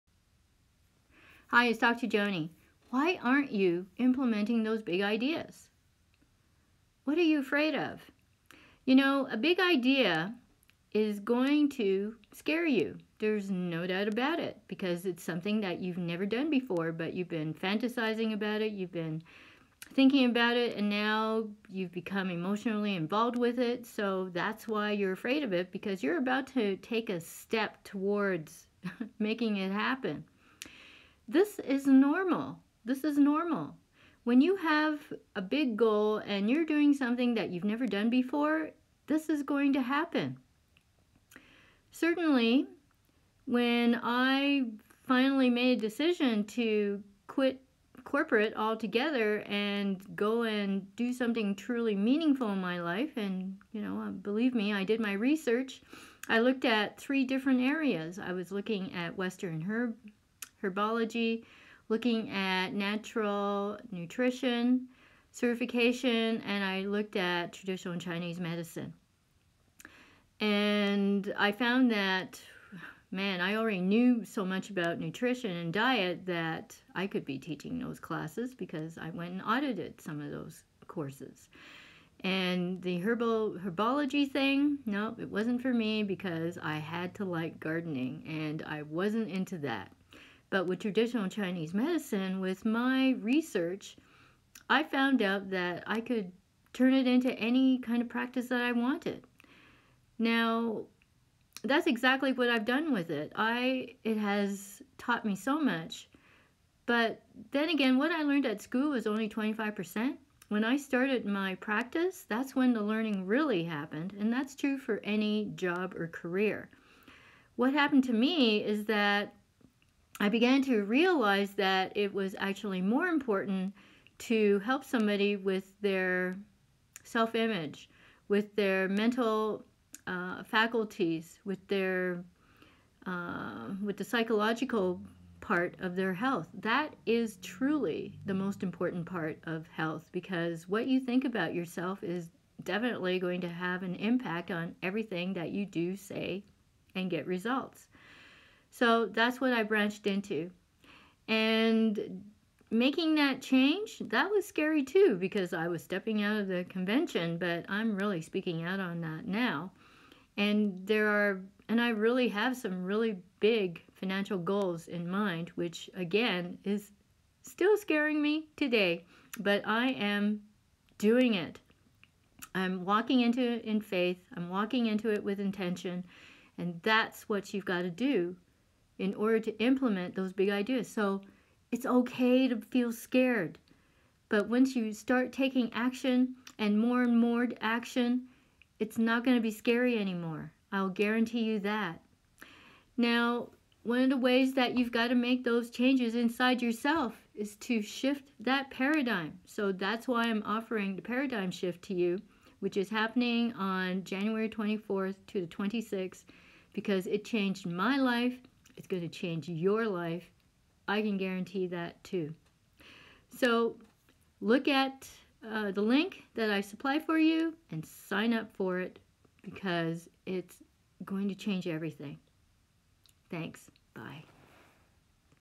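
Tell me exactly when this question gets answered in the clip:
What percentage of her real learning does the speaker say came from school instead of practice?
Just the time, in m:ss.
1:49.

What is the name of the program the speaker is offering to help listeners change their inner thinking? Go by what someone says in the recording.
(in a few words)
the paradigm shift.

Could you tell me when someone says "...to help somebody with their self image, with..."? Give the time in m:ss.
2:04.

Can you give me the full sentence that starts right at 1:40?
Now, that's exactly what I've done with it.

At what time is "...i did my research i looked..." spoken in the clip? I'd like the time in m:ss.
0:54.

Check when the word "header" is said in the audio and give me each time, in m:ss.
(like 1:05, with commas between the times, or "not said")
not said.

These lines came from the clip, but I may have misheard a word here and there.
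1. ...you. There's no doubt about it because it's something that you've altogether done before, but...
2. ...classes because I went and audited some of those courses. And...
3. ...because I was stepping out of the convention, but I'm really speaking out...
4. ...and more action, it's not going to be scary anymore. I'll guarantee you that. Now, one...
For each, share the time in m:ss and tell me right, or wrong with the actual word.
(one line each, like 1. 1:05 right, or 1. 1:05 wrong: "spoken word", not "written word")
1. 0:12 wrong: "never", not "altogether"
2. 1:17 right
3. 2:35 right
4. 3:07 right.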